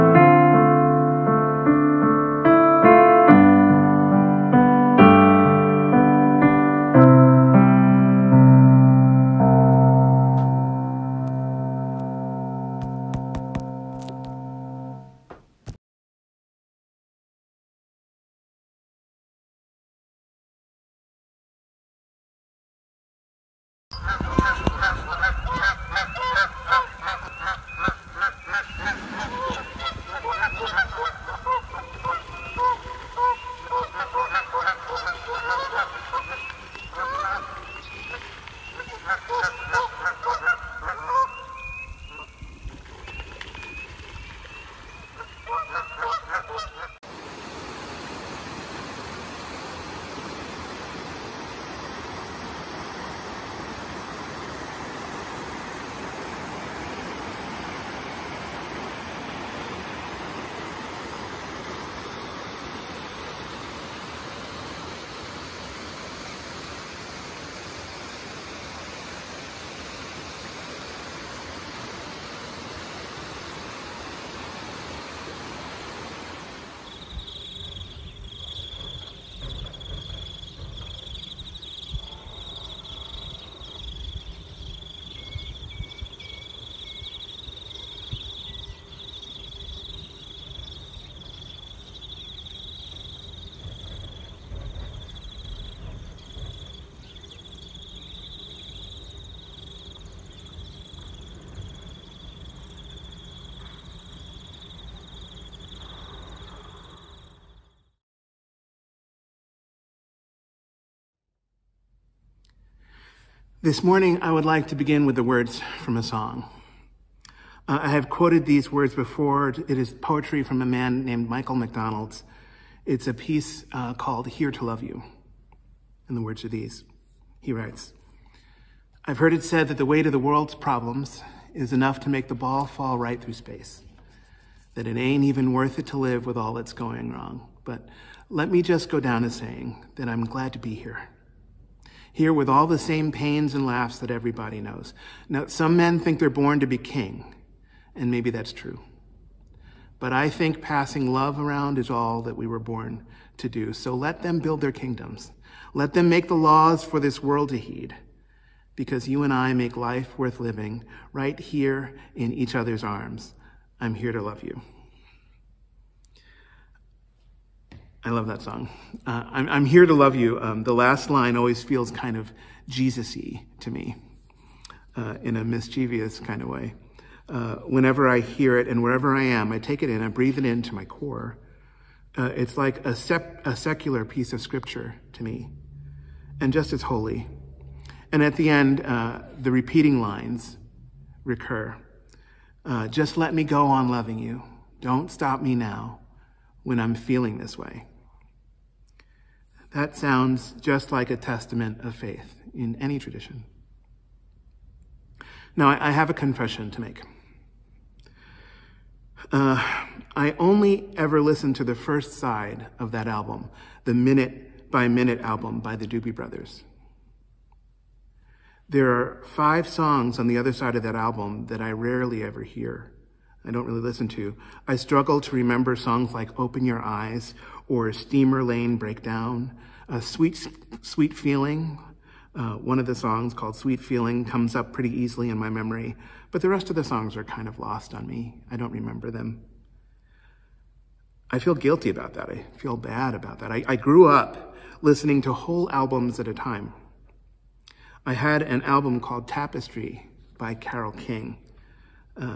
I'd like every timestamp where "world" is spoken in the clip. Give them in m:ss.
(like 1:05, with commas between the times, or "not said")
2:10, 2:37.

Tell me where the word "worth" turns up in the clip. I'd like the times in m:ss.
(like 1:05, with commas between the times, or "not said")
2:15, 2:40.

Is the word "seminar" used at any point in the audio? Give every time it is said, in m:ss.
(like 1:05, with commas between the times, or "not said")
not said.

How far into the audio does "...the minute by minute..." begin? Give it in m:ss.
3:33.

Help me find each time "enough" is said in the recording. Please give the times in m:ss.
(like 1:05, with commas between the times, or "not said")
2:11.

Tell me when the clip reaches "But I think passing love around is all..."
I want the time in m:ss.
2:30.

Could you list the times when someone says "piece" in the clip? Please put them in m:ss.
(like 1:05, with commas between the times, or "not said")
2:03, 3:04.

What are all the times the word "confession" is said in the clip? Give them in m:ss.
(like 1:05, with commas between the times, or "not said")
3:26.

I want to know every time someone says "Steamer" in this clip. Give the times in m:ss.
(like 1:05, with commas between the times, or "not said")
3:47.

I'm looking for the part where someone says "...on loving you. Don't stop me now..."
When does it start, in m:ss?
3:13.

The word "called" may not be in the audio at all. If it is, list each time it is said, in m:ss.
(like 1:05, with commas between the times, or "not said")
2:03, 3:53, 4:08.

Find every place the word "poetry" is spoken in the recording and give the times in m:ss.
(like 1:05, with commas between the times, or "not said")
1:59.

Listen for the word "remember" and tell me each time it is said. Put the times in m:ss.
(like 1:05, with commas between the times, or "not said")
3:45, 3:58.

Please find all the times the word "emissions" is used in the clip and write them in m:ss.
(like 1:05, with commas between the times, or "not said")
not said.